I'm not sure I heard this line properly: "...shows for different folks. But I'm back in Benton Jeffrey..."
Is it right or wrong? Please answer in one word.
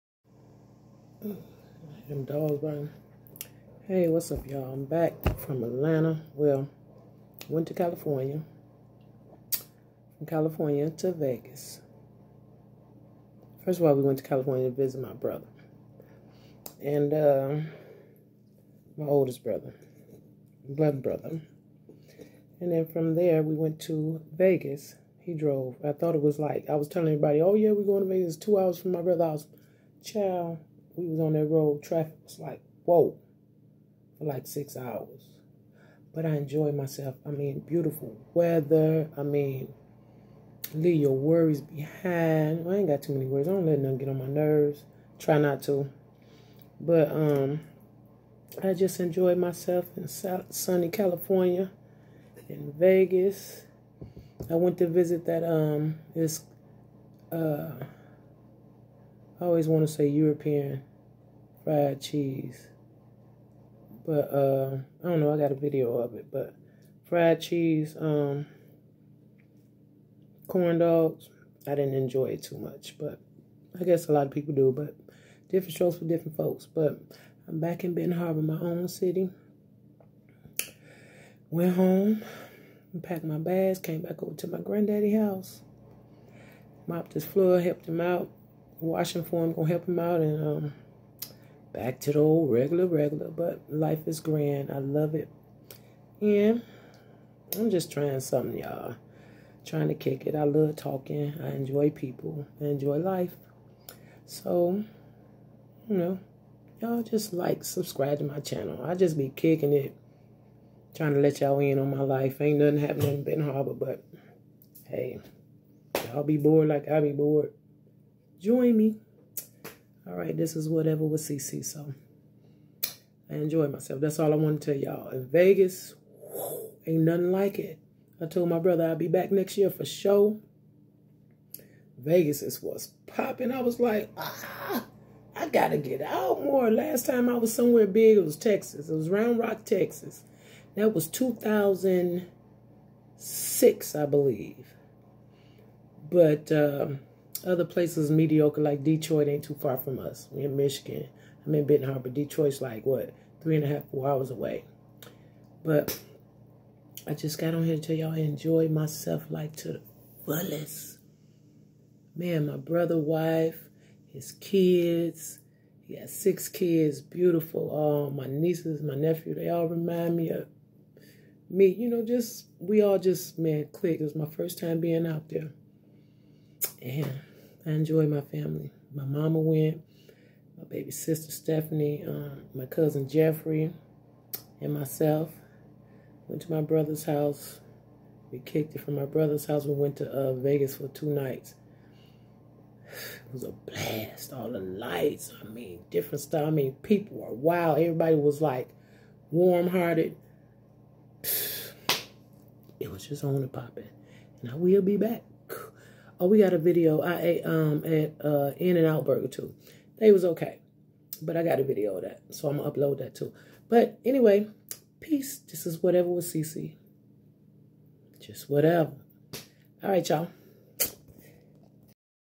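wrong.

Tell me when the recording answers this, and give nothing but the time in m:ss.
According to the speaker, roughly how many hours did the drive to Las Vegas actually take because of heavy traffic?
0:34.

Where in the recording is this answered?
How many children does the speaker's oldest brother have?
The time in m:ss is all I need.
2:46.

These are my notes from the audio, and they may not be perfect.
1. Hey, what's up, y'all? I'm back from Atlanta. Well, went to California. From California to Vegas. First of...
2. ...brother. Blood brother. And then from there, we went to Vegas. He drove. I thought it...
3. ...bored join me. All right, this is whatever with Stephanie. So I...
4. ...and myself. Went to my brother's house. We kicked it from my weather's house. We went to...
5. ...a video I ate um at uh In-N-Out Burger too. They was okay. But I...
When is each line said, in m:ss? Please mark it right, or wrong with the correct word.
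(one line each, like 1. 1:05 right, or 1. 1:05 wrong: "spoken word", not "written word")
1. 0:03 right
2. 0:19 right
3. 1:57 wrong: "Ceecee", not "Stephanie"
4. 3:04 wrong: "brother", not "weather"
5. 3:26 right.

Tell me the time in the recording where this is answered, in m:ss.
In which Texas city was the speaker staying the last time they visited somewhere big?
2:19.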